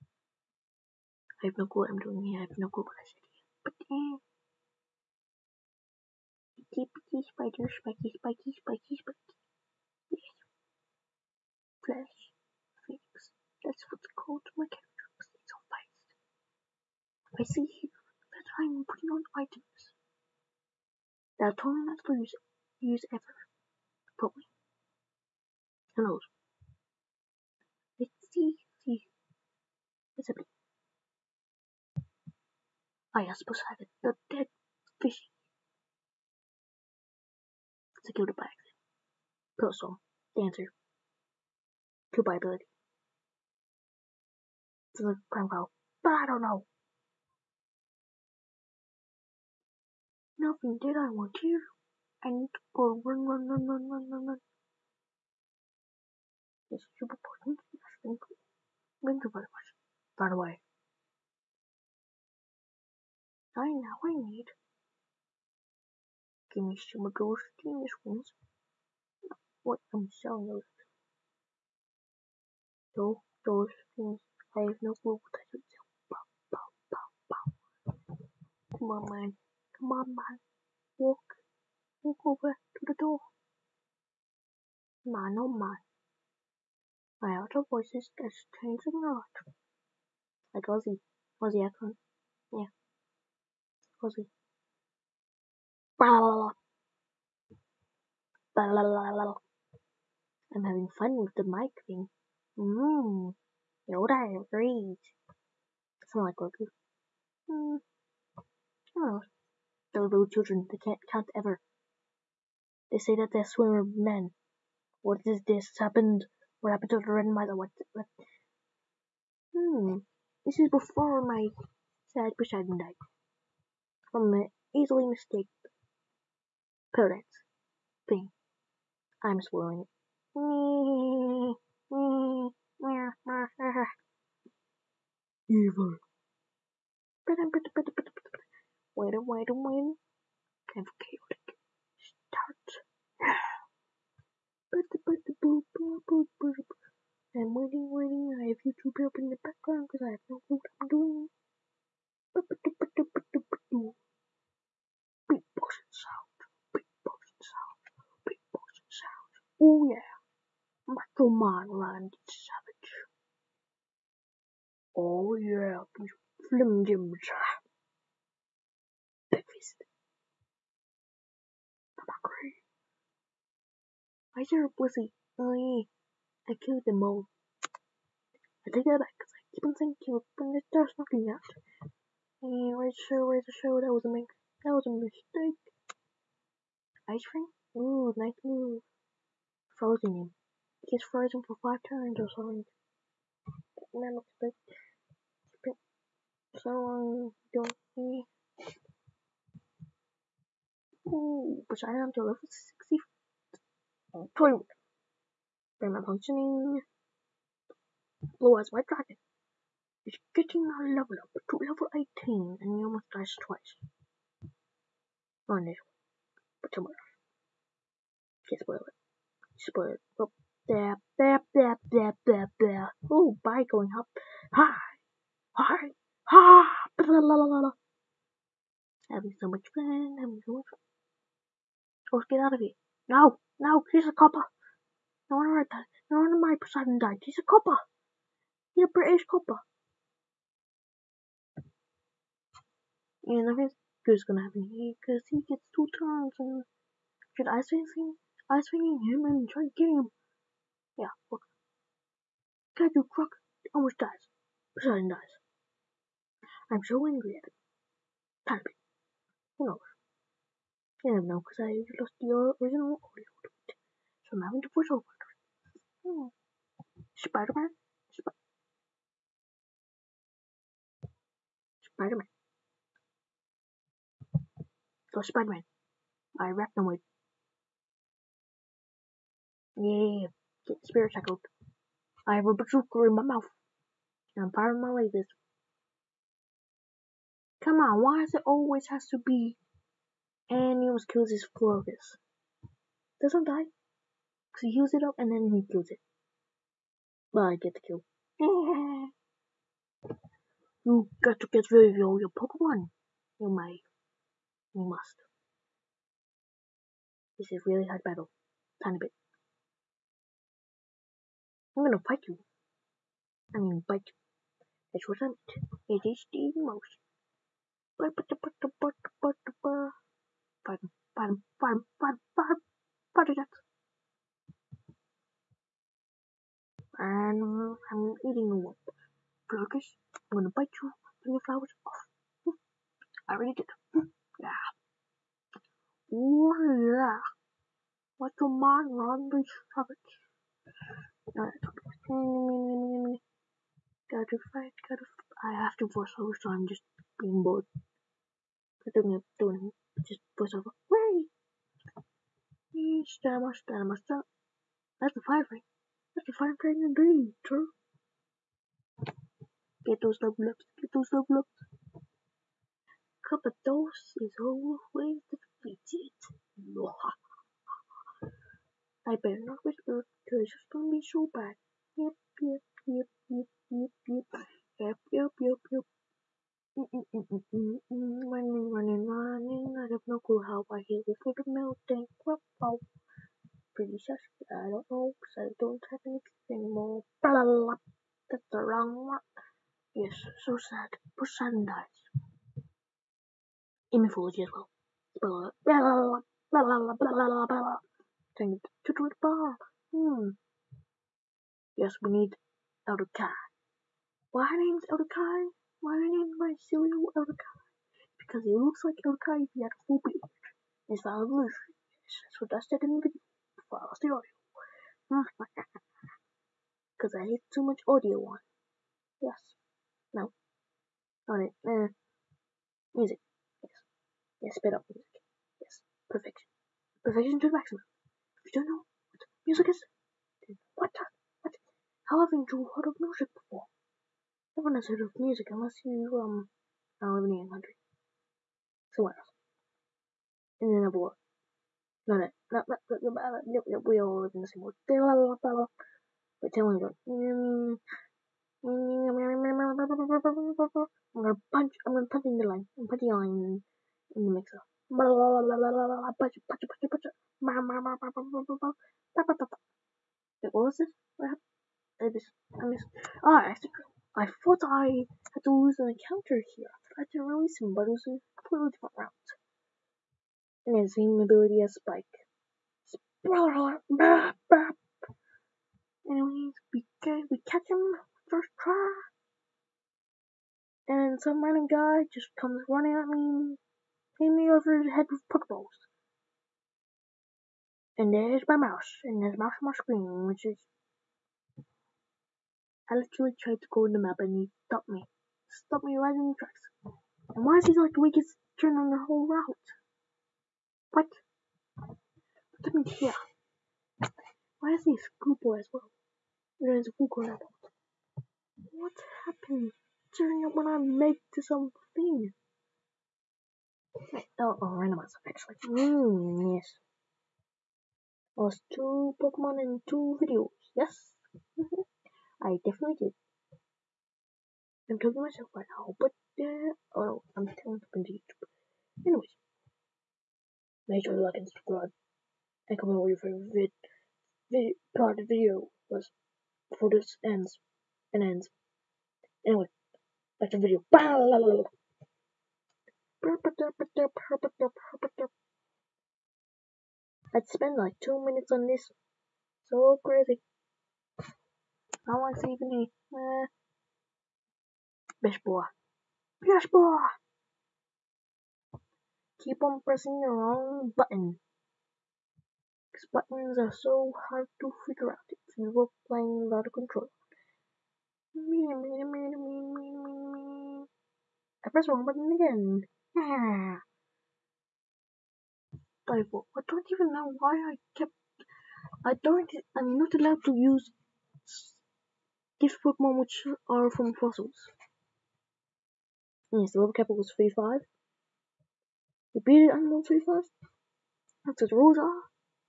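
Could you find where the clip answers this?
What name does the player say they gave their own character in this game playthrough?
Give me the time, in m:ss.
0:12.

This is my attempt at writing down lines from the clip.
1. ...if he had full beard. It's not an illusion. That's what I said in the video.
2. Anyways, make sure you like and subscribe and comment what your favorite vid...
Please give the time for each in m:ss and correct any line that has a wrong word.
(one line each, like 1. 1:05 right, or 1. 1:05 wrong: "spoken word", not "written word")
1. 6:49 right
2. 8:49 right.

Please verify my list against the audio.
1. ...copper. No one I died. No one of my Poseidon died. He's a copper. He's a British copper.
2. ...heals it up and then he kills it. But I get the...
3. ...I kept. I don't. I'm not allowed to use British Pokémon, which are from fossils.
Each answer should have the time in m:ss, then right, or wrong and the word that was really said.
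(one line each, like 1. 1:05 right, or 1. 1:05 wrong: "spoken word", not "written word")
1. 3:54 right
2. 4:54 right
3. 9:37 wrong: "Gift", not "British".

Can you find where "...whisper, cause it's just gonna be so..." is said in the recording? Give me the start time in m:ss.
6:09.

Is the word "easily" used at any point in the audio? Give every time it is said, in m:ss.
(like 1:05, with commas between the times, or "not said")
2:04.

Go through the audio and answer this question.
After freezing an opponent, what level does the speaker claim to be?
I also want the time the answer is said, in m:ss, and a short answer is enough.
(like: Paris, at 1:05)
64, at 3:22.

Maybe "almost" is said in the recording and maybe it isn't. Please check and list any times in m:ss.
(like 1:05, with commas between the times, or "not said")
3:32, 4:13, 4:50.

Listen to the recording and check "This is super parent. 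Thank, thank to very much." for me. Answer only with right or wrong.
wrong.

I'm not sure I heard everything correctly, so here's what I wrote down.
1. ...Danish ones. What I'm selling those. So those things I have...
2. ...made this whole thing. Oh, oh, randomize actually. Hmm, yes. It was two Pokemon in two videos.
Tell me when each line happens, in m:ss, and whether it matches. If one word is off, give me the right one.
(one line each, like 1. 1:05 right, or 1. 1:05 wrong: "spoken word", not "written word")
1. 1:07 right
2. 8:30 right.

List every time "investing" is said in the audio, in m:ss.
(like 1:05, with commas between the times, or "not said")
not said.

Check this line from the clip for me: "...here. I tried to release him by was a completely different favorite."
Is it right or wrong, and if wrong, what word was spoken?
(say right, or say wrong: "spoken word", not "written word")
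wrong: "route", not "favorite".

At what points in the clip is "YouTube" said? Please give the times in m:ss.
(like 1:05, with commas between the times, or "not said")
2:28, 8:48.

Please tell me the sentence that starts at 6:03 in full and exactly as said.
Cup of dose is always defeated.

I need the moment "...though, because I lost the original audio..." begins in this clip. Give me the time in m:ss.
4:21.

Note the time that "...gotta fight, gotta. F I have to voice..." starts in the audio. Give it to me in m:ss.
5:44.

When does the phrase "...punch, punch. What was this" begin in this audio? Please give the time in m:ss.
7:36.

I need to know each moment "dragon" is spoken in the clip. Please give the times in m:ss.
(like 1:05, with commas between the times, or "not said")
3:28.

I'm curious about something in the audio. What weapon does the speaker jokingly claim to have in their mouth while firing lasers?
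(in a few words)
A bazooka.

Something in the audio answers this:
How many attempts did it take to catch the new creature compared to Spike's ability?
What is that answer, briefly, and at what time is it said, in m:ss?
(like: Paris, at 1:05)
First try, at 7:58.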